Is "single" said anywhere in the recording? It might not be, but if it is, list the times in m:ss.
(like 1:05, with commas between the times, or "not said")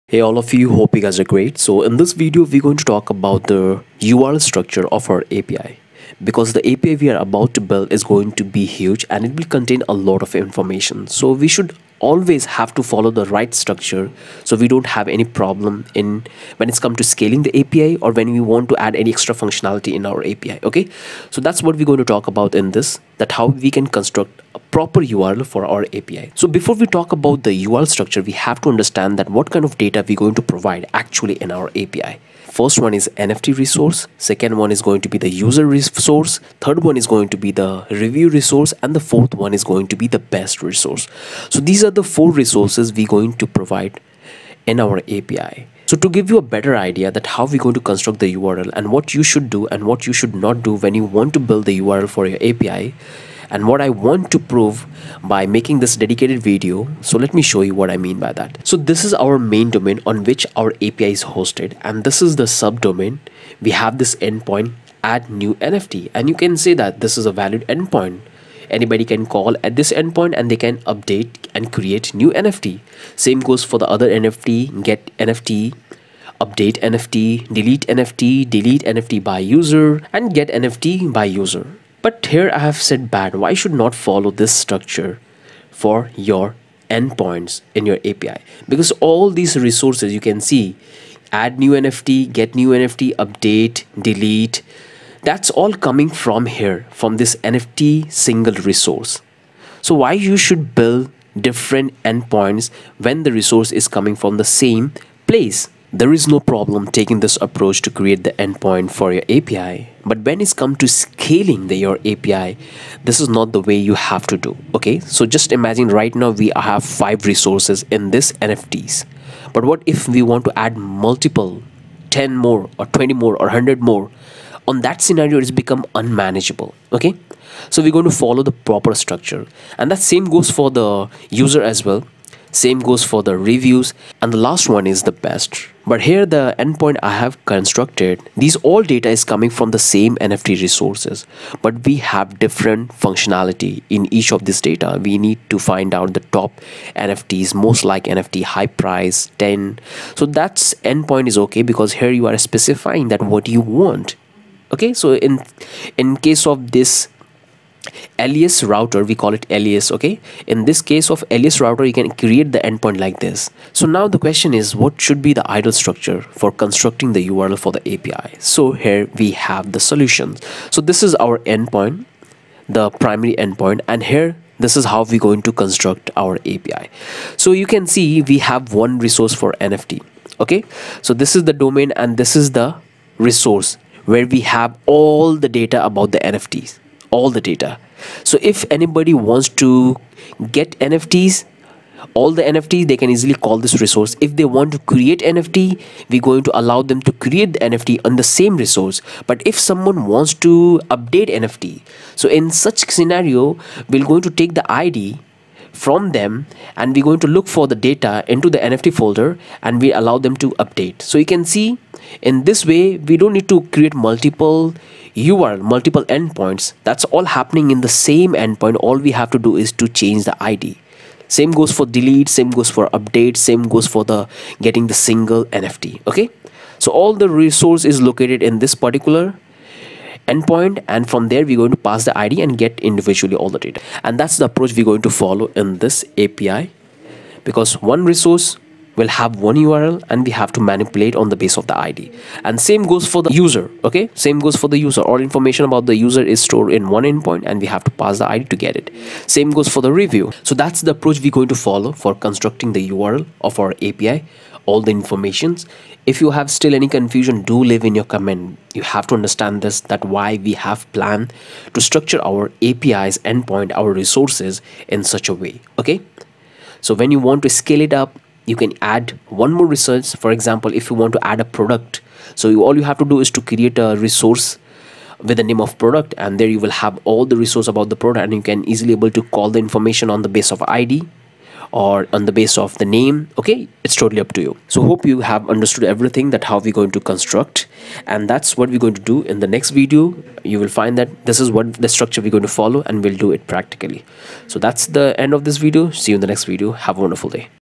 1:38, 3:44.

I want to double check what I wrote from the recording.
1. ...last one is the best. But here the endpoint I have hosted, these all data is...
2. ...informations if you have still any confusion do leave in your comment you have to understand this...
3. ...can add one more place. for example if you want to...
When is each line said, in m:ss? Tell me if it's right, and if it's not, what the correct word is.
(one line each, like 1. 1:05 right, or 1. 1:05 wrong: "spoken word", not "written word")
1. 2:14 wrong: "constructed", not "hosted"
2. 4:14 right
3. 4:28 wrong: "resource", not "place".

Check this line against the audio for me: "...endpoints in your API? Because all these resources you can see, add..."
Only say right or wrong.
right.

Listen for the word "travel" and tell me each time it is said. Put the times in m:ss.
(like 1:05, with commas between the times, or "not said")
not said.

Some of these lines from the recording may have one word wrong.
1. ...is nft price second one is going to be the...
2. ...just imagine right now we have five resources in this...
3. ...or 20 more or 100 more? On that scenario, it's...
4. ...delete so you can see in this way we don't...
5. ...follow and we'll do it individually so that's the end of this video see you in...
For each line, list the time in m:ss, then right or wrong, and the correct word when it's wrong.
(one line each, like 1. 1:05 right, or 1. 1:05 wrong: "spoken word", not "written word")
1. 0:32 wrong: "resource", not "price"
2. 1:55 right
3. 2:02 right
4. 3:30 wrong: "update", not "delete"
5. 4:52 wrong: "practically", not "individually".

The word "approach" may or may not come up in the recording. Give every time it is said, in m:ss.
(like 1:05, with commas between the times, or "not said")
1:47, 3:54, 4:10.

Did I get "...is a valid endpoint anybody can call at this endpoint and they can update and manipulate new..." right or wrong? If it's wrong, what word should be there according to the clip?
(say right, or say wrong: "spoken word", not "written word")
wrong: "create", not "manipulate".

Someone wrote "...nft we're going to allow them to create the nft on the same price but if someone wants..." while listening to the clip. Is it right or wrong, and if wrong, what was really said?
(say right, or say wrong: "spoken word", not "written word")
wrong: "resource", not "price".